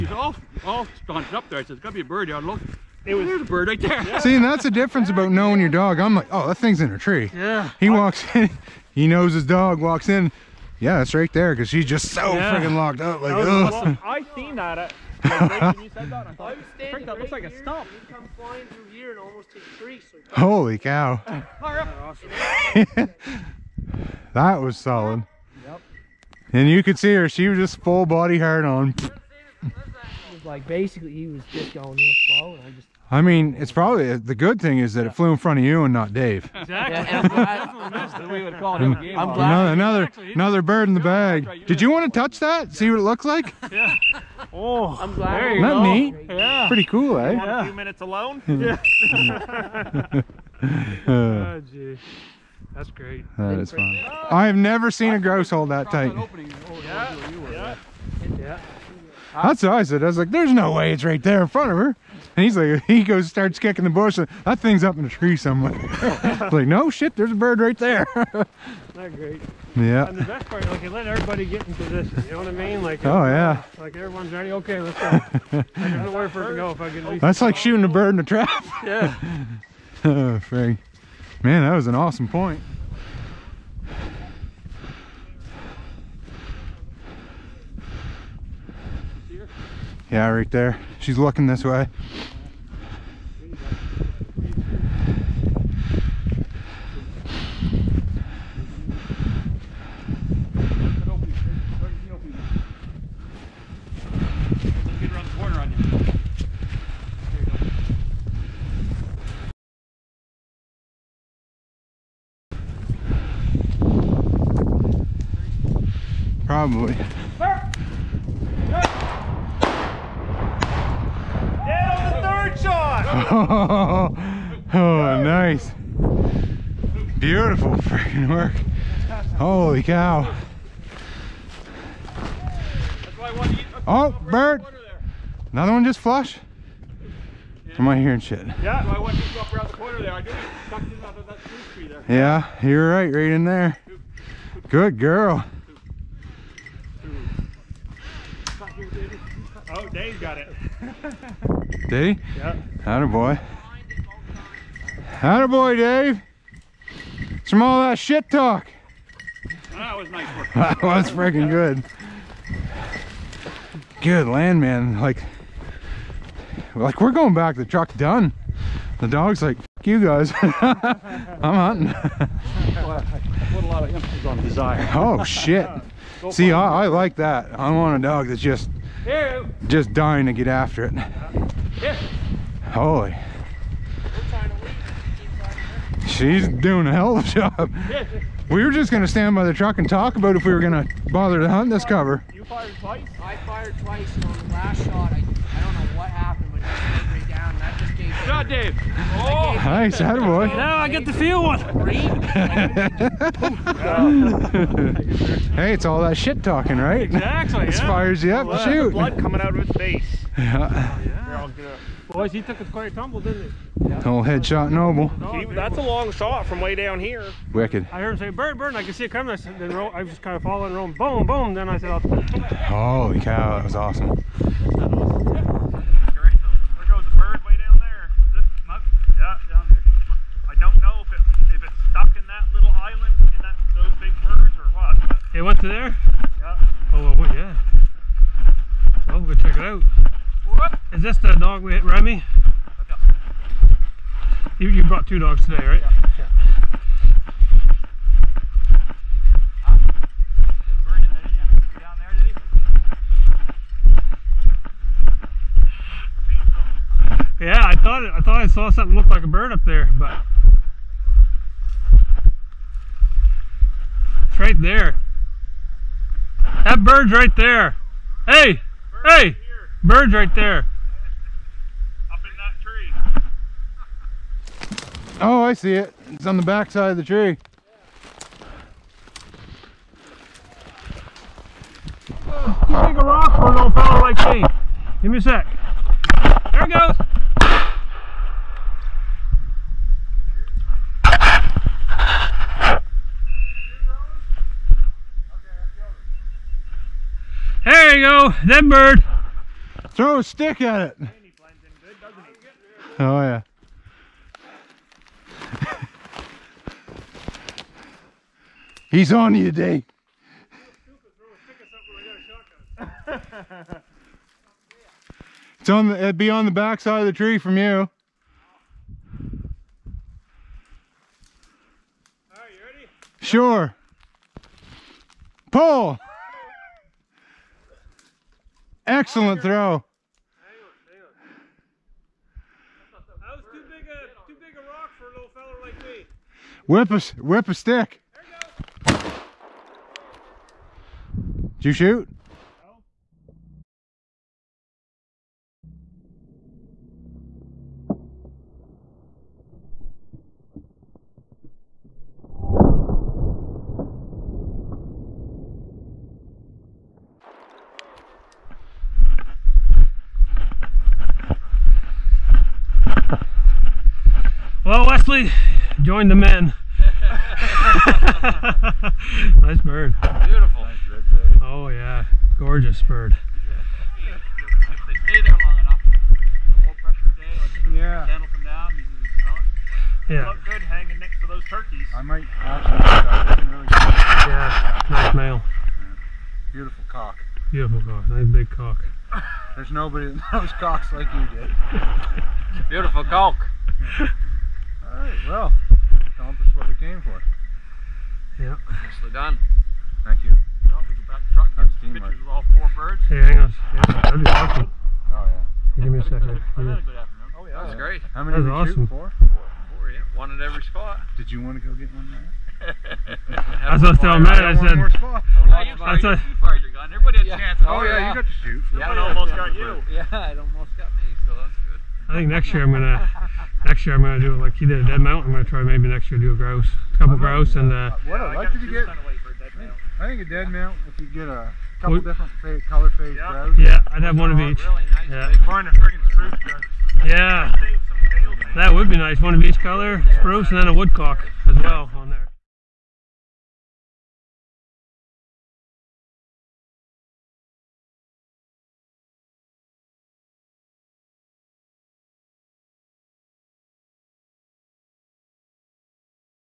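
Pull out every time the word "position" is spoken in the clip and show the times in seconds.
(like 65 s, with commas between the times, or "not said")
71 s.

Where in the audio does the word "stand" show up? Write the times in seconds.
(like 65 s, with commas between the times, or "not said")
189 s.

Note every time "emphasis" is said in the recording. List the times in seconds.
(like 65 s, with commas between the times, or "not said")
173 s.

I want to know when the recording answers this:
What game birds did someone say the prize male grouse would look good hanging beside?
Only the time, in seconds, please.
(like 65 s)
381 s.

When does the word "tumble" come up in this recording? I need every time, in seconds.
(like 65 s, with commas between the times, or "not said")
212 s.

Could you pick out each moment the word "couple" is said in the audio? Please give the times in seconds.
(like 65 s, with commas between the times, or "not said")
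426 s, 431 s.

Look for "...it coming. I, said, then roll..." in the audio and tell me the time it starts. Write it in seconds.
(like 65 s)
219 s.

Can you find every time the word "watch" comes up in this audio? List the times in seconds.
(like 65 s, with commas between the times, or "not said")
not said.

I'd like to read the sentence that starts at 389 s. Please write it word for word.
There's nobody that knows cocks like you did.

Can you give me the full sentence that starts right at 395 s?
Alright, well, accomplished what we came for.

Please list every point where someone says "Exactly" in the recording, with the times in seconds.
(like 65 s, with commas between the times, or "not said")
36 s, 207 s.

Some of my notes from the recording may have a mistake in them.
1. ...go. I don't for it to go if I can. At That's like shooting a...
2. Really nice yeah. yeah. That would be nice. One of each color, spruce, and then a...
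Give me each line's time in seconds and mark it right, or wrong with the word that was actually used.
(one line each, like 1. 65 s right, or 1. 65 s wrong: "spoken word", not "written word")
1. 74 s right
2. 434 s right.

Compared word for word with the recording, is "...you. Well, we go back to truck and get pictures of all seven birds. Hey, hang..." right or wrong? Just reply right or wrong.
wrong.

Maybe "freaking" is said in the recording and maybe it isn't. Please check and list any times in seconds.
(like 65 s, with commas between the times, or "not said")
12 s, 127 s, 161 s.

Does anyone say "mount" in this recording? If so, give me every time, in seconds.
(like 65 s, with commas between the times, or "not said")
425 s, 430 s.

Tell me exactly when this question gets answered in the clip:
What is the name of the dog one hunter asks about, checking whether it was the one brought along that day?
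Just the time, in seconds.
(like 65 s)
241 s.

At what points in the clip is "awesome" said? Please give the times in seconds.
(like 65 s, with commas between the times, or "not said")
81 s, 223 s, 404 s, 408 s.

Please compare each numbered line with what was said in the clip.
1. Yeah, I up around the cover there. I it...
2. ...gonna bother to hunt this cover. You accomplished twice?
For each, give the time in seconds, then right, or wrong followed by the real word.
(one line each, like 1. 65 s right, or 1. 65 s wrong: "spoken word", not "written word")
1. 138 s wrong: "corner", not "cover"
2. 190 s wrong: "fired", not "accomplished".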